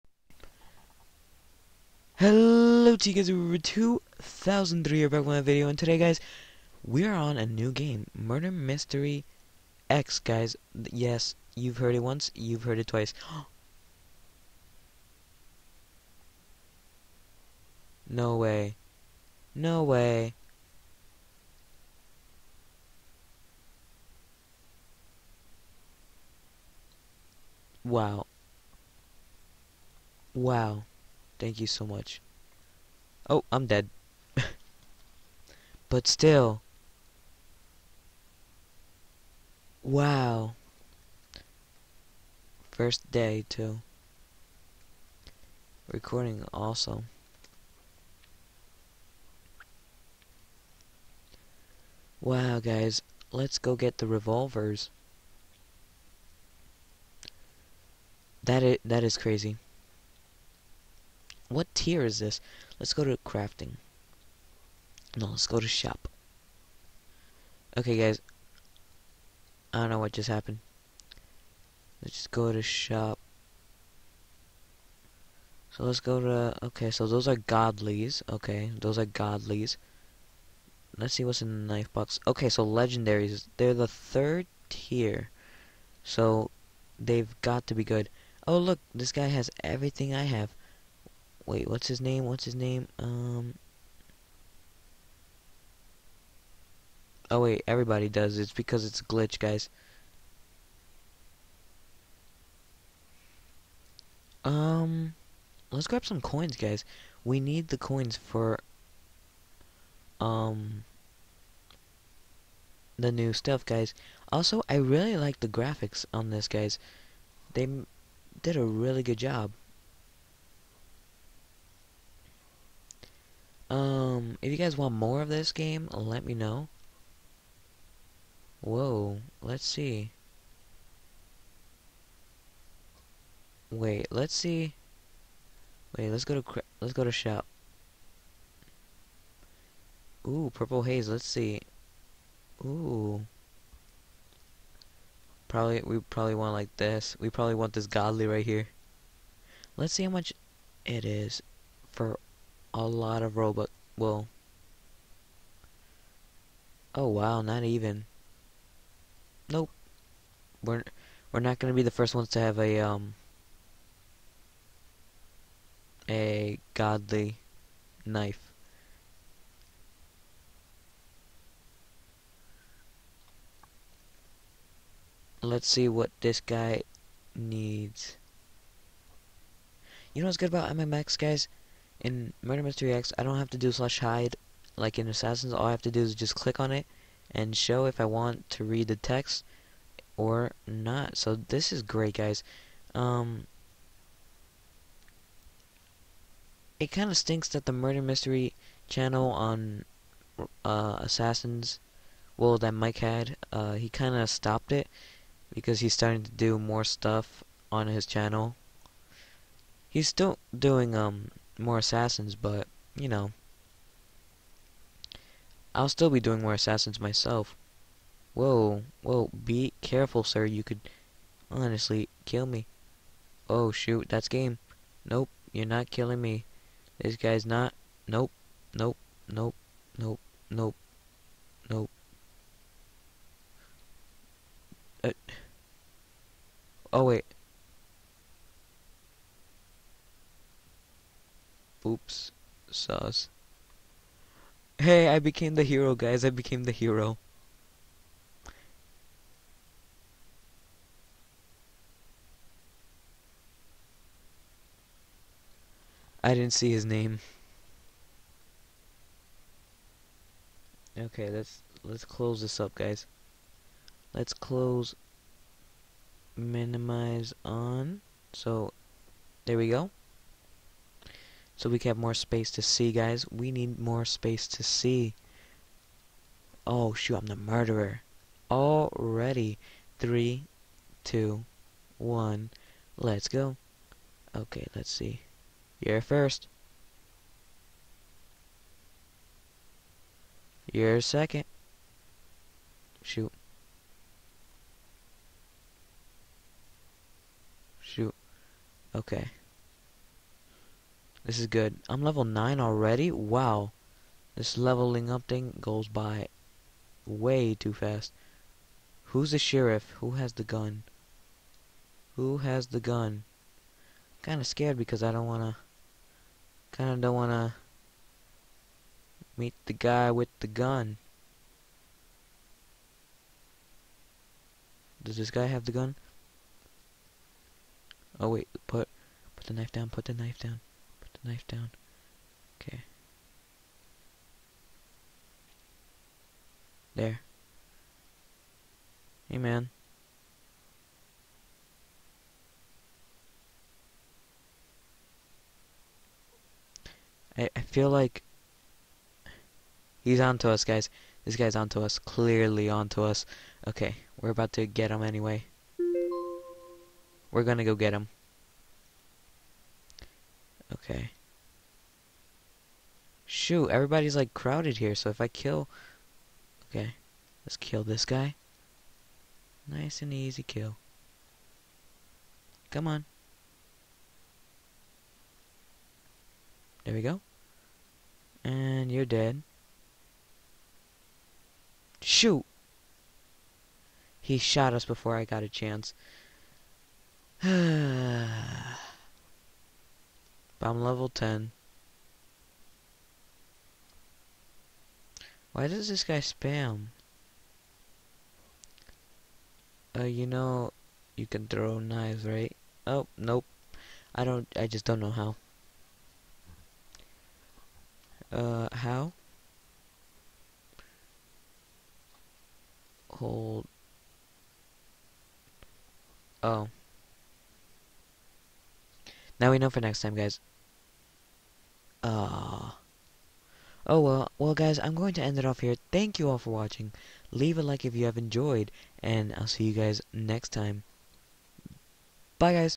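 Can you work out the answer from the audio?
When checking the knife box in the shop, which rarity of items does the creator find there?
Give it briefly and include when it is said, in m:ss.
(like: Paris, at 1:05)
Legendaries, at 1:22.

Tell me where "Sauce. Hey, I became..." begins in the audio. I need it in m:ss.
4:02.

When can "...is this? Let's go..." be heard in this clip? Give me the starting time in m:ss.
1:02.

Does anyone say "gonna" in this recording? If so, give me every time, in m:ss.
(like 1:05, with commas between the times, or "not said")
2:41, 5:57.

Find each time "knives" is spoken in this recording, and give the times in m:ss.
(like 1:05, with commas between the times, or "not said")
6:41.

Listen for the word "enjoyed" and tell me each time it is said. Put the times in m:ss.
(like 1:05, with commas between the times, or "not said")
7:08.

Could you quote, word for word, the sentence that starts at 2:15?
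Wait, let's go to let's go to shop.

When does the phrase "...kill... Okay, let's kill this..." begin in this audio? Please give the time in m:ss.
6:05.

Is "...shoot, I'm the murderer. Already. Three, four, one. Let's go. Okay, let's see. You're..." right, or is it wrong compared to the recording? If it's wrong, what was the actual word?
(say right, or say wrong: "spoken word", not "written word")
wrong: "two", not "four".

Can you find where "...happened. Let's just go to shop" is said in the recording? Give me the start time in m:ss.
1:10.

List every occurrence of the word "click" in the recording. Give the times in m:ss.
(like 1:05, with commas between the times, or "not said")
3:06.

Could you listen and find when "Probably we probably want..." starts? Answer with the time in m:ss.
2:25.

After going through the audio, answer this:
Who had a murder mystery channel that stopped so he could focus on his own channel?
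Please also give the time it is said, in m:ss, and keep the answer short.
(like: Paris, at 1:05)
Mike, at 3:22.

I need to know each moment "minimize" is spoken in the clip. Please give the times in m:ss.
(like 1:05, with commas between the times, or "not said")
4:26.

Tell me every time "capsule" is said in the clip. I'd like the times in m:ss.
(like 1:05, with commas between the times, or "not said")
not said.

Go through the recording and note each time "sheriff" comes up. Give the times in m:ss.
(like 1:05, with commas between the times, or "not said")
5:09.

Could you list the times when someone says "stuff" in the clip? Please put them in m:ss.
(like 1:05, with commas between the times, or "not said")
1:53, 3:26.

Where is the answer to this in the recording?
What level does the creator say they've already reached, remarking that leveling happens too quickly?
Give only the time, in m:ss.
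5:02.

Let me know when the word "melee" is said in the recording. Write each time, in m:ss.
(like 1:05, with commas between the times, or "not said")
not said.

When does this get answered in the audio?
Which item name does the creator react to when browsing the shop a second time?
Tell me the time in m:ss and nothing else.
2:20.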